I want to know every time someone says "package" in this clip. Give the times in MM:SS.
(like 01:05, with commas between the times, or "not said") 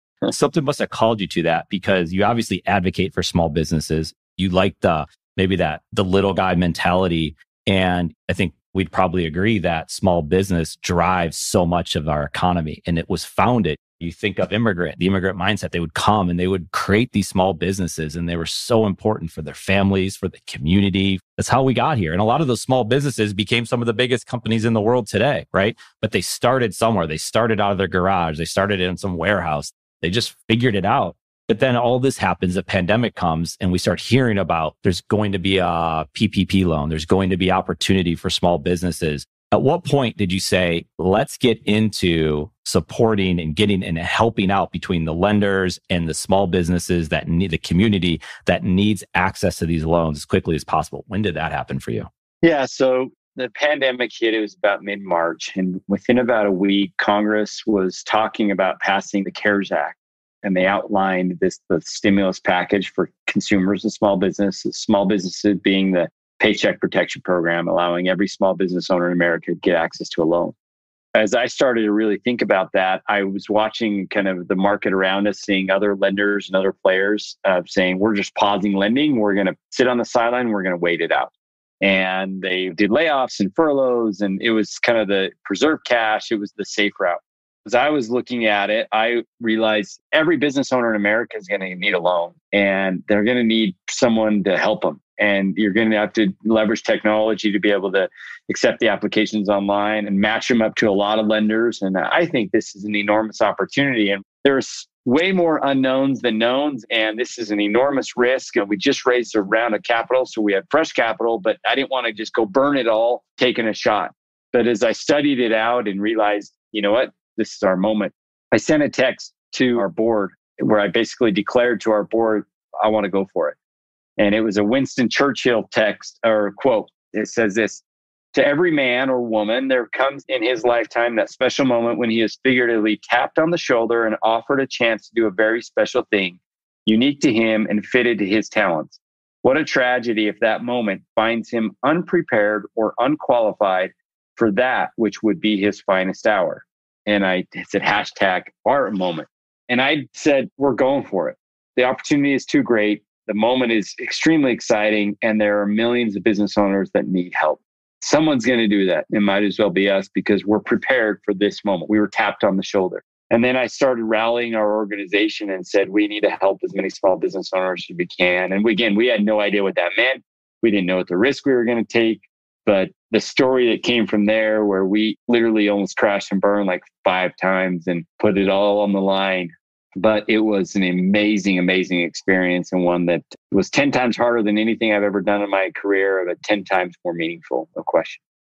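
01:02.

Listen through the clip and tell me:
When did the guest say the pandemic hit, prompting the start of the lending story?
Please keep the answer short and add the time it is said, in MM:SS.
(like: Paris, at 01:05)
Mid March, at 00:54.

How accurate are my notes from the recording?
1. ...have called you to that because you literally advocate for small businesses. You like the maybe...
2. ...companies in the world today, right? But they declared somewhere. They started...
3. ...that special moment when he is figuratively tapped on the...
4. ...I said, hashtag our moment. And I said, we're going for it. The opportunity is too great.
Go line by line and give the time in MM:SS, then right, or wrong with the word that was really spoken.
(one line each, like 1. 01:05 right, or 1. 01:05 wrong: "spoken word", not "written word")
1. 00:00 wrong: "obviously", not "literally"
2. 00:24 wrong: "started", not "declared"
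3. 02:11 right
4. 02:27 right.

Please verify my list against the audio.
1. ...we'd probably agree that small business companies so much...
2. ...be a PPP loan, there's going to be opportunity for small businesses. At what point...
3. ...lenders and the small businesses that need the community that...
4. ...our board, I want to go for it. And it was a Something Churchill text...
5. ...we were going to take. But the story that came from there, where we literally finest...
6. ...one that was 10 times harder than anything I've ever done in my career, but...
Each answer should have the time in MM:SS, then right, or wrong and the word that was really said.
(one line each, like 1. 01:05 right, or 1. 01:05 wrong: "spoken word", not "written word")
1. 00:08 wrong: "drives", not "companies"
2. 00:35 right
3. 00:45 right
4. 02:01 wrong: "Winston", not "Something"
5. 02:51 wrong: "almost", not "finest"
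6. 03:02 right.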